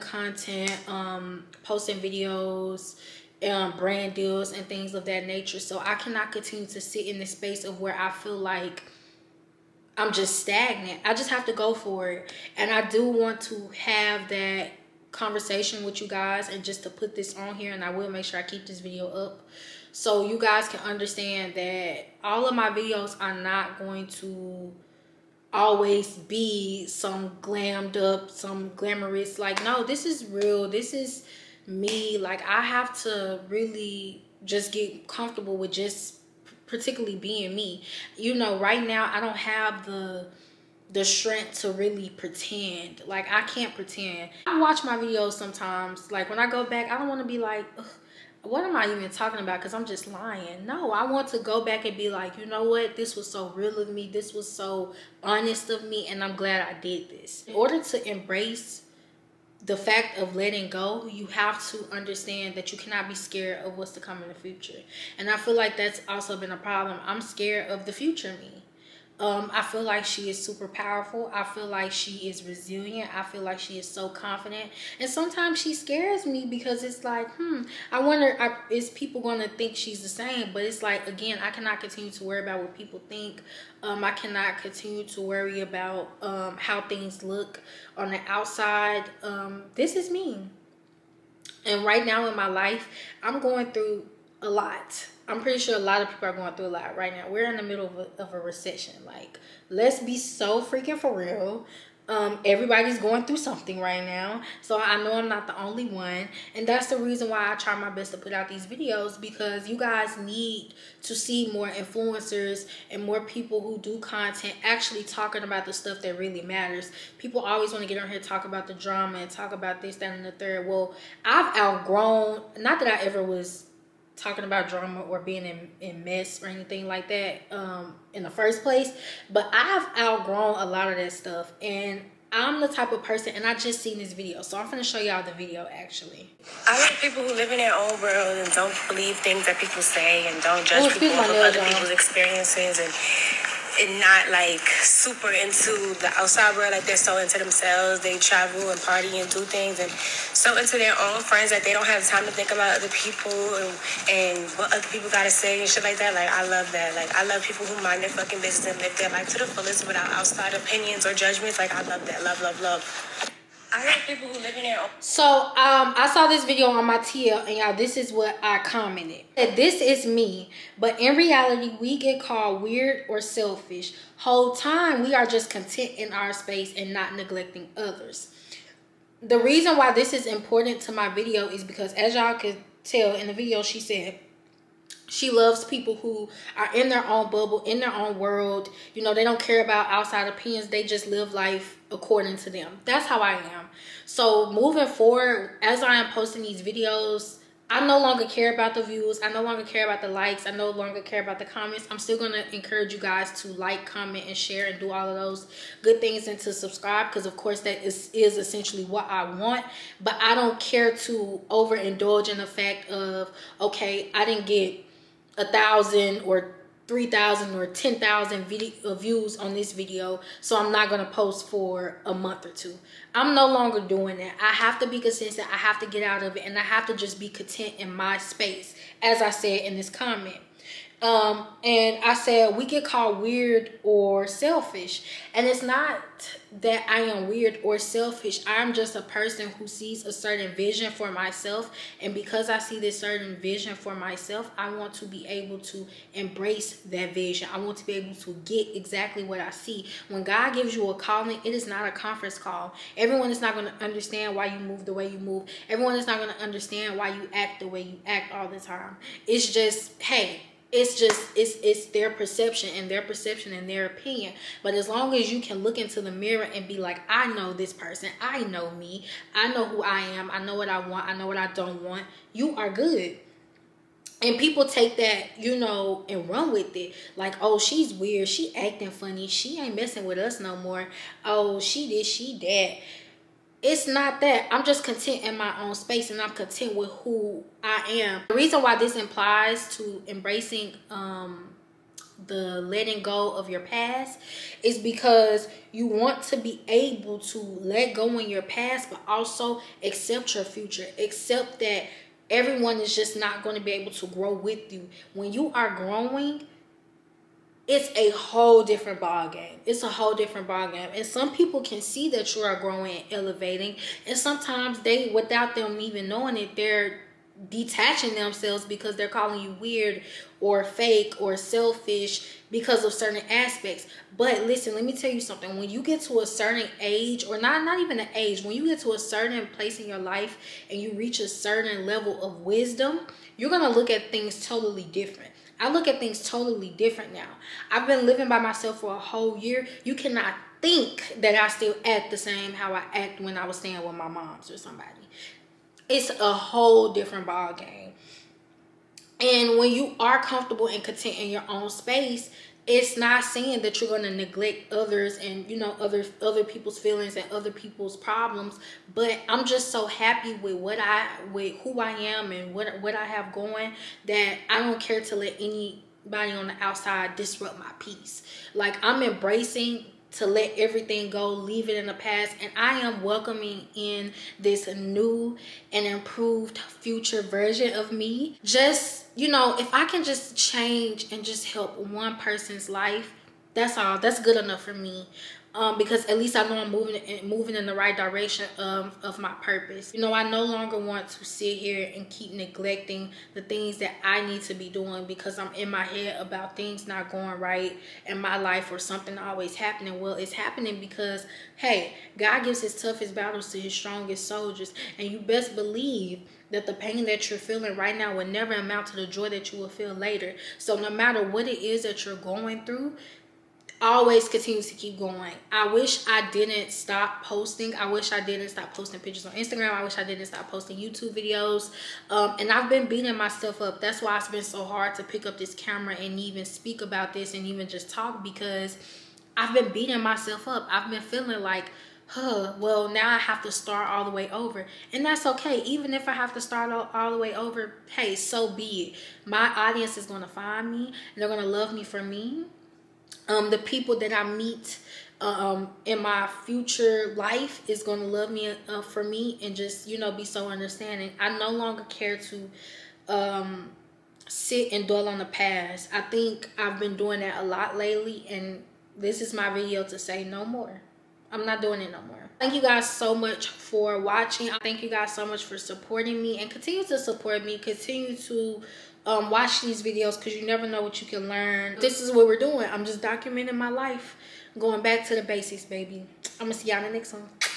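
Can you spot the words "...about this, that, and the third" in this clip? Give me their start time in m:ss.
1:59.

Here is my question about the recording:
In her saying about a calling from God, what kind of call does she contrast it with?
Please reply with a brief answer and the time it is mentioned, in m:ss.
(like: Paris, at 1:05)
a conference call, at 4:11.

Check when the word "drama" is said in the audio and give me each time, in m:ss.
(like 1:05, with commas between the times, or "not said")
1:58, 2:04.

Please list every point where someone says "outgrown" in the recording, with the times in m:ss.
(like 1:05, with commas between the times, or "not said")
2:01, 2:09.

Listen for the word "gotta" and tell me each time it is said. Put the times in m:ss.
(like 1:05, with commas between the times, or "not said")
2:35.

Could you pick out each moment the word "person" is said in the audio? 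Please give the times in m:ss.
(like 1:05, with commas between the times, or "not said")
2:13, 3:59, 4:27, 6:22.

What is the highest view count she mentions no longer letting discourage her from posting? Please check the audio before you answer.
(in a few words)
10,000.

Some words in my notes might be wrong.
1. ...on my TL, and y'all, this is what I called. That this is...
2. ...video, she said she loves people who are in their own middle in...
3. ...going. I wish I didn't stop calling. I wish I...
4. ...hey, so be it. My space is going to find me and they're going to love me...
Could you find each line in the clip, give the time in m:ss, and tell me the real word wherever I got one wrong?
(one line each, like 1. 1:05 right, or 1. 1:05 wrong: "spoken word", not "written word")
1. 2:46 wrong: "commented", not "called"
2. 3:03 wrong: "bubble", not "middle"
3. 6:54 wrong: "posting", not "calling"
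4. 7:17 wrong: "audience", not "space".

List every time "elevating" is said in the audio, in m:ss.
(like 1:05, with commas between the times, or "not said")
5:13.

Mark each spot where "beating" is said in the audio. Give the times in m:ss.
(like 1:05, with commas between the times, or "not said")
7:02, 7:09.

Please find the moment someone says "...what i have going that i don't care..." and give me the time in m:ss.
6:02.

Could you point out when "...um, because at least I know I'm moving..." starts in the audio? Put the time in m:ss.
6:25.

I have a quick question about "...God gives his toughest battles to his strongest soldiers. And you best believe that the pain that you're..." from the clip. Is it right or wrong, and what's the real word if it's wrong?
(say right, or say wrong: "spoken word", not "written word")
right.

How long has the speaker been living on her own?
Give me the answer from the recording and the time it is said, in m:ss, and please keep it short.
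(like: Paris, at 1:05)
a whole year, at 5:38.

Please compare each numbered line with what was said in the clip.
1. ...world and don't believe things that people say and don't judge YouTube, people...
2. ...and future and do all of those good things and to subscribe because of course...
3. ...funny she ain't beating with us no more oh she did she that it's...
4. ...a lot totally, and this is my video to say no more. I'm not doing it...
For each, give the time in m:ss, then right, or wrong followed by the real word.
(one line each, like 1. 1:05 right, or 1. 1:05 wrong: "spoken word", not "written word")
1. 2:18 wrong: "Ooh", not "YouTube"
2. 3:24 wrong: "share", not "future"
3. 4:38 wrong: "messing", not "beating"
4. 7:37 wrong: "lately", not "totally".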